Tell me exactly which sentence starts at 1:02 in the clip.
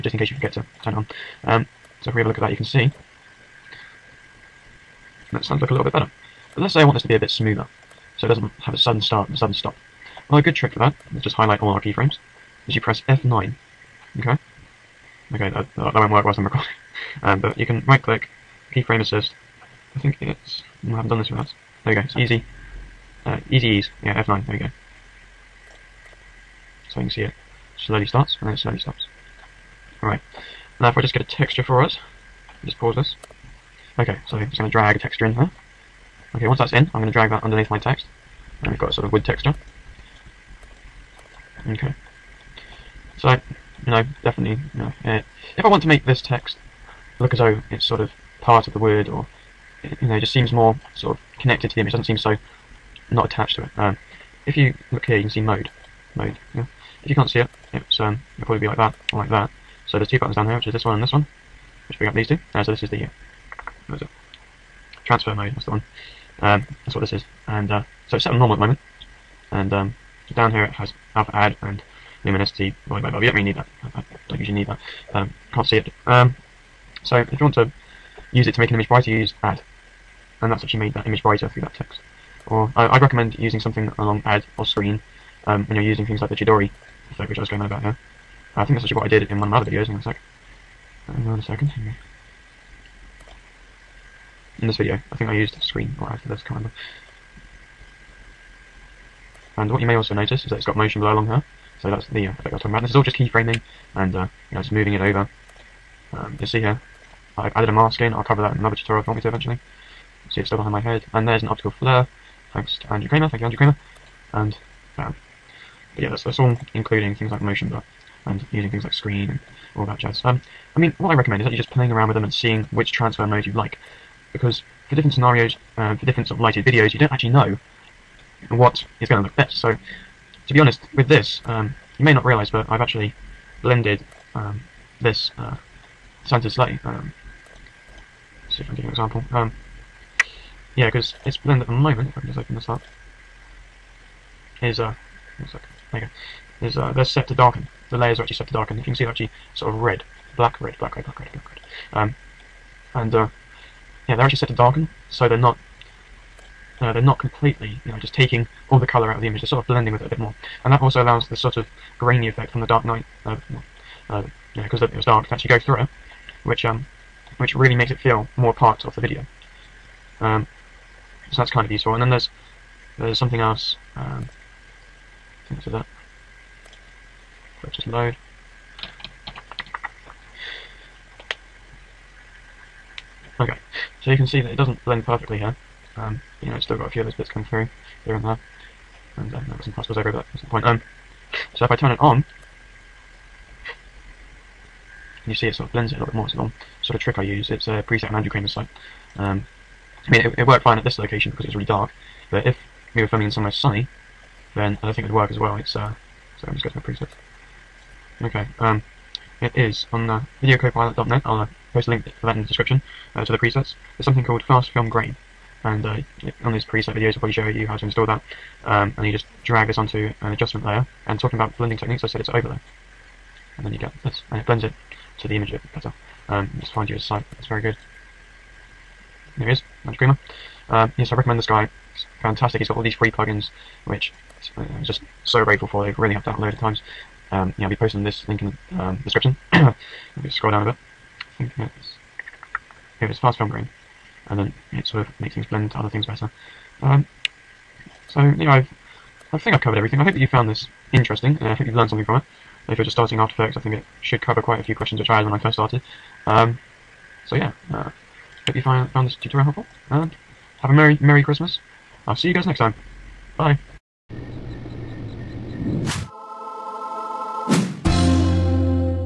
Uh, so this is the uh, transfer mode, that's the one.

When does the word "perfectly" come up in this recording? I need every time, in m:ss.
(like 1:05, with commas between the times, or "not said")
3:05.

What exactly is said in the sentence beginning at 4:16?
Um, so yeah, uh, hope you find, found this tutorial helpful, and have a merry, merry Christmas.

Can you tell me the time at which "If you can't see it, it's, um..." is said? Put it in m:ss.
0:57.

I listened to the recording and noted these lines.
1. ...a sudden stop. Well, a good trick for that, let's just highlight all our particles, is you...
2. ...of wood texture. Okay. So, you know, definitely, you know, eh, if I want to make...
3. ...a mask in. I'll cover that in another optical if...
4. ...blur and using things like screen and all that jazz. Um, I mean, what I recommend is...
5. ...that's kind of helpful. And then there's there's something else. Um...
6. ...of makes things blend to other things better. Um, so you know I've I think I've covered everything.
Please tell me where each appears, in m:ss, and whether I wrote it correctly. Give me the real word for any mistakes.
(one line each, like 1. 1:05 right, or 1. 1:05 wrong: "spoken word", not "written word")
1. 0:09 wrong: "keyframes", not "particles"
2. 0:39 right
3. 1:47 wrong: "tutorial", not "optical"
4. 1:57 right
5. 2:51 wrong: "useful", not "helpful"
6. 4:05 right.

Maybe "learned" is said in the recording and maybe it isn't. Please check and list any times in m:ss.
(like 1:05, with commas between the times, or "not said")
4:11.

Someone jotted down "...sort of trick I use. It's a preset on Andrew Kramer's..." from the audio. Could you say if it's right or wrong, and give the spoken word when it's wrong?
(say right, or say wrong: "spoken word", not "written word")
right.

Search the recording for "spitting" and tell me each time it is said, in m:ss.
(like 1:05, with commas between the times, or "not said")
not said.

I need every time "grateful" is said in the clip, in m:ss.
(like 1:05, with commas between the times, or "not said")
3:55.